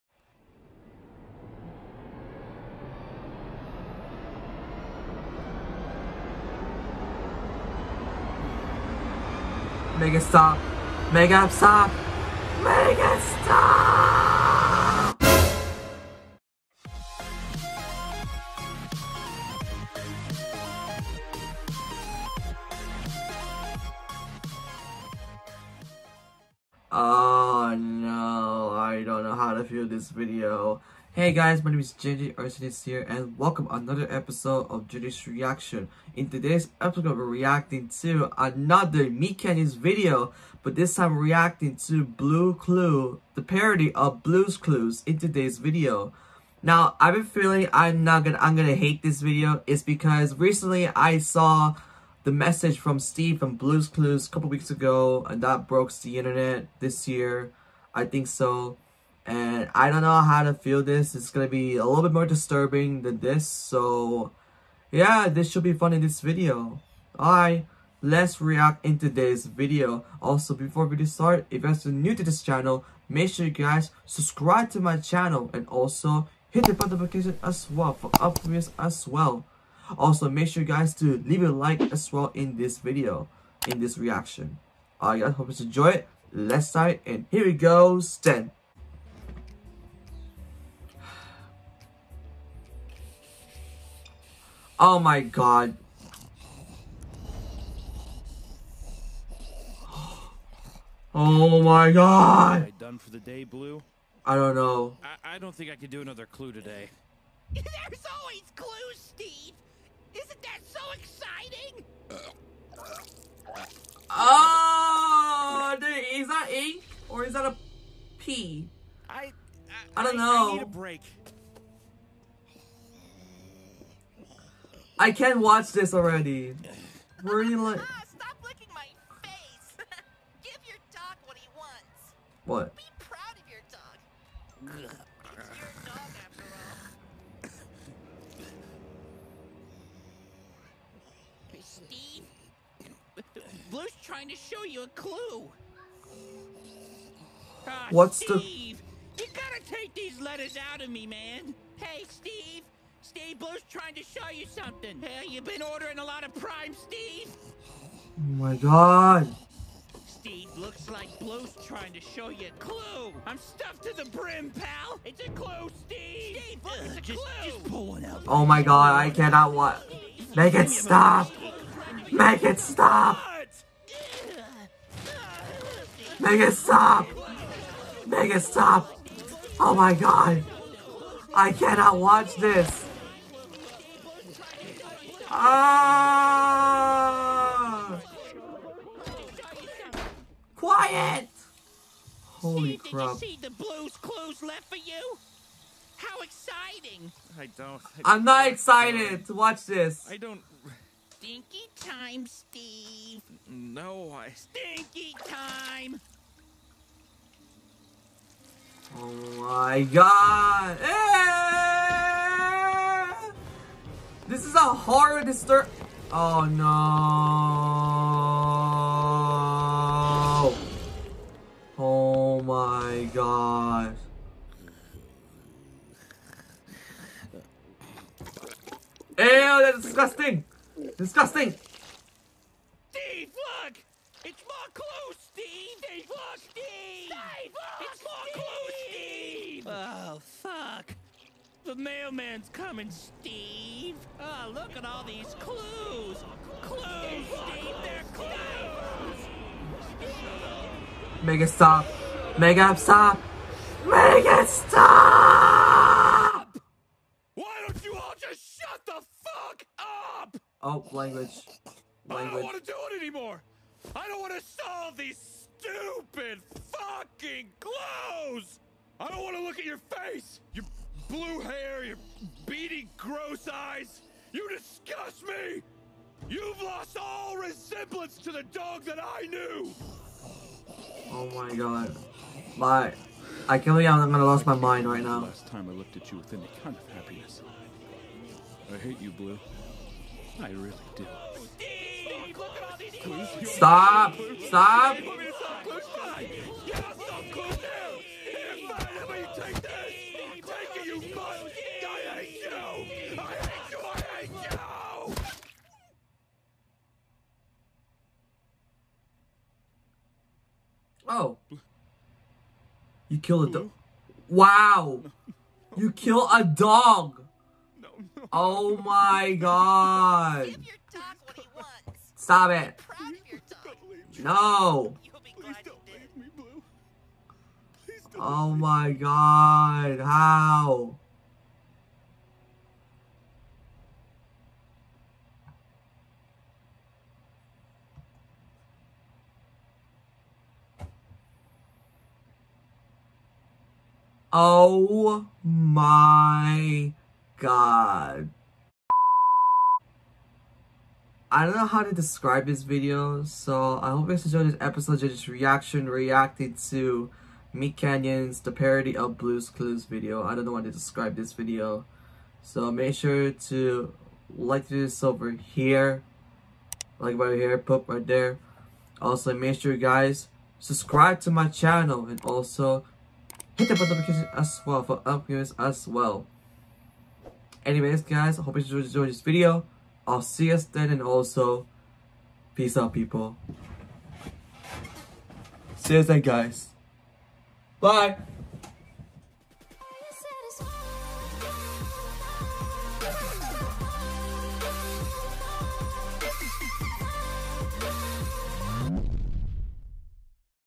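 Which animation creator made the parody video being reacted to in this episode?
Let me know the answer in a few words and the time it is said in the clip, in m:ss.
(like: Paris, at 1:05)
MeatCanyon, at 0:39.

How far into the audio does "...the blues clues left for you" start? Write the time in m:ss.
3:13.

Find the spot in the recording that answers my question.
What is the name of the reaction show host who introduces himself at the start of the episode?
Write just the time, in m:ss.
0:31.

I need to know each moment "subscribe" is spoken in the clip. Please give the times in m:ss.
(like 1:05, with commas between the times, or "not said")
1:14, 6:10.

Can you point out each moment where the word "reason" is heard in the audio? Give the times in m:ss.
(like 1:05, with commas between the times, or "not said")
not said.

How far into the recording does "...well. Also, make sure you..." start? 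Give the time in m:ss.
1:19.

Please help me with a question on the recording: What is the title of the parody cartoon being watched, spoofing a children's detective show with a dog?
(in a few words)
Bloo Cloo.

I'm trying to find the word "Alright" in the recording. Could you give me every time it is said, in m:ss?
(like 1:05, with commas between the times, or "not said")
1:07, 1:25.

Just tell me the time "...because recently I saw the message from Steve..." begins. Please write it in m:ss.
0:49.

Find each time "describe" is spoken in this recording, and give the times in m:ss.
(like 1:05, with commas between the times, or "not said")
5:51, 6:00.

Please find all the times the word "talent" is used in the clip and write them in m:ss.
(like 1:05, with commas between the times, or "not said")
not said.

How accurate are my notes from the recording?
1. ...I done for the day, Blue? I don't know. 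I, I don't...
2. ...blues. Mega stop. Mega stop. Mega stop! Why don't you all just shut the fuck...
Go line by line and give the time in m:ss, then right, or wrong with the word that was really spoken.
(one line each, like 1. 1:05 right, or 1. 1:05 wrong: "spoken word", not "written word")
1. 1:42 right
2. 4:08 wrong: "clues", not "blues".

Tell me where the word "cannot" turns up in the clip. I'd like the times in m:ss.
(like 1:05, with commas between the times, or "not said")
2:49, 3:01.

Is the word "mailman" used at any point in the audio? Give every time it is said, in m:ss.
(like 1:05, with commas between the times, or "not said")
4:01.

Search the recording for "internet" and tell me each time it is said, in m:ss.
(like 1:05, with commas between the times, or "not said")
0:56.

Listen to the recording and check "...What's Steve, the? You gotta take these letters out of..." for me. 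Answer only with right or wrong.
right.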